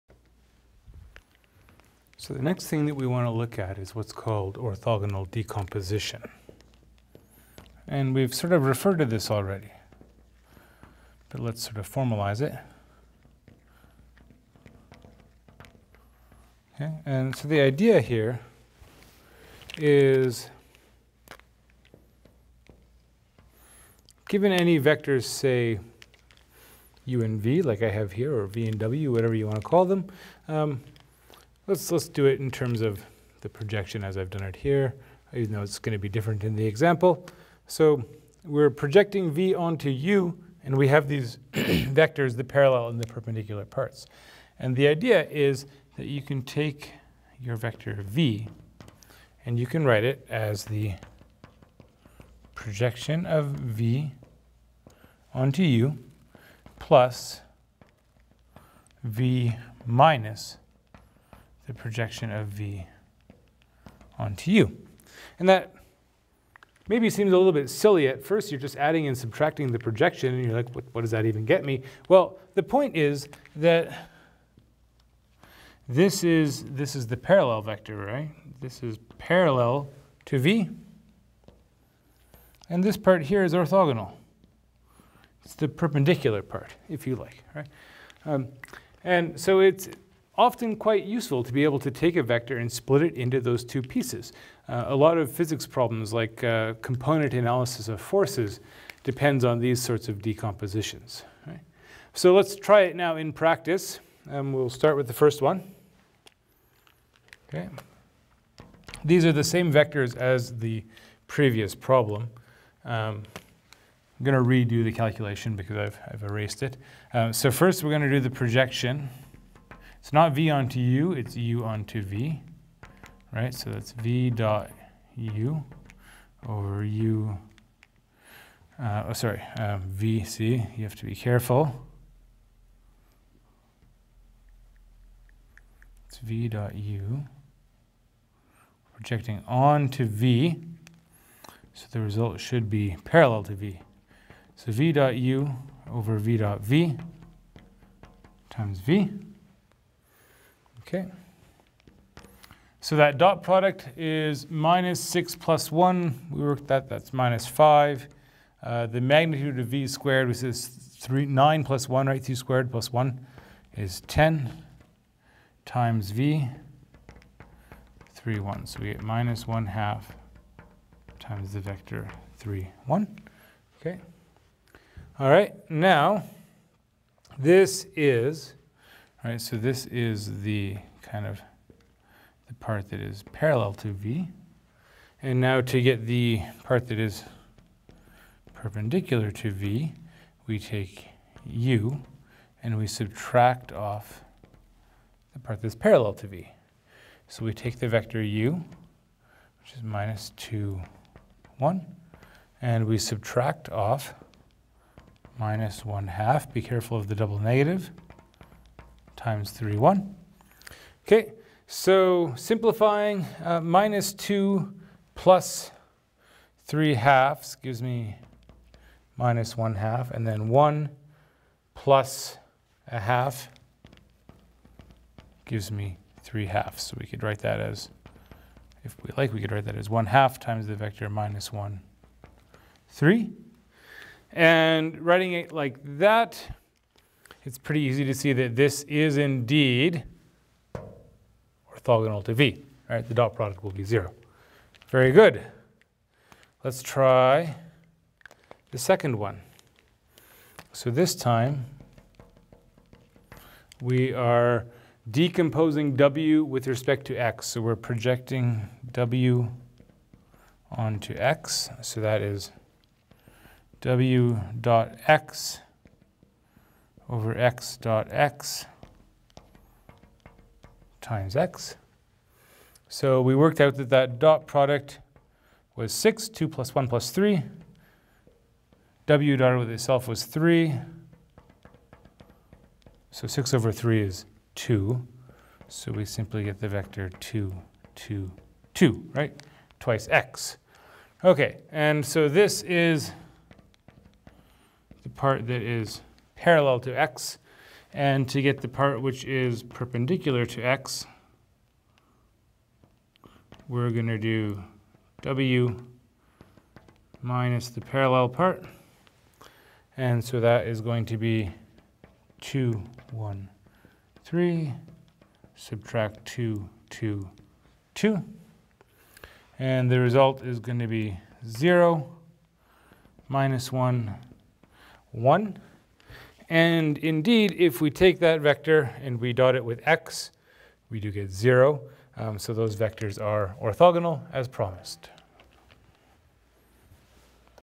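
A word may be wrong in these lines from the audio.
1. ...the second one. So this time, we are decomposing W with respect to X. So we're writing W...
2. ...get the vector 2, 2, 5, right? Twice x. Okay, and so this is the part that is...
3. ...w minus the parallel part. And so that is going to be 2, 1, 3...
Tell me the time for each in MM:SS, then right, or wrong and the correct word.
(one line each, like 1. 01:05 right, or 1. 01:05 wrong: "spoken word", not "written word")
1. 04:08 wrong: "projecting", not "writing"
2. 04:46 wrong: "2", not "5"
3. 05:05 right.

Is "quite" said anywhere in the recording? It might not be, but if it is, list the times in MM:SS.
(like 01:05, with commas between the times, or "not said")
01:30.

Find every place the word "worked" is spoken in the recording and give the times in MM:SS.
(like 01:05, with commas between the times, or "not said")
02:36, 04:33.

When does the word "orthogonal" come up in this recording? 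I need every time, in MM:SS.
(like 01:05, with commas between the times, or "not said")
00:04, 01:23, 04:01, 05:33.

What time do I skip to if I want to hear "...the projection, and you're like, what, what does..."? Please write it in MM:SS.
01:09.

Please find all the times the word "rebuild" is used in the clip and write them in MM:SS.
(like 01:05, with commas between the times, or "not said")
not said.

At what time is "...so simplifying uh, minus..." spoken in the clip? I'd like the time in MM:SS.
03:31.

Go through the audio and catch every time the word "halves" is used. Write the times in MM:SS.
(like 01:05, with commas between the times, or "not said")
03:36, 03:46.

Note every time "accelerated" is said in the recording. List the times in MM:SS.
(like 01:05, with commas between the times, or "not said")
not said.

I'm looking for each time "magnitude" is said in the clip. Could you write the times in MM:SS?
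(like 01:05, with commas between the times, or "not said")
02:39.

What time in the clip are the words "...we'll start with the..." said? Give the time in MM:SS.
01:44.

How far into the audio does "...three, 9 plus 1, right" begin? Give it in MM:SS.
02:40.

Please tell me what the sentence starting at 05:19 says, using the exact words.
And the result is going to be 0, minus 1, 1.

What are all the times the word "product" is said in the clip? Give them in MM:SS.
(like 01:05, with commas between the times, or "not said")
02:33, 04:03, 04:34.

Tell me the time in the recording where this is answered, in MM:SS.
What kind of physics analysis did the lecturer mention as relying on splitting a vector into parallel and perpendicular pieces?
01:36.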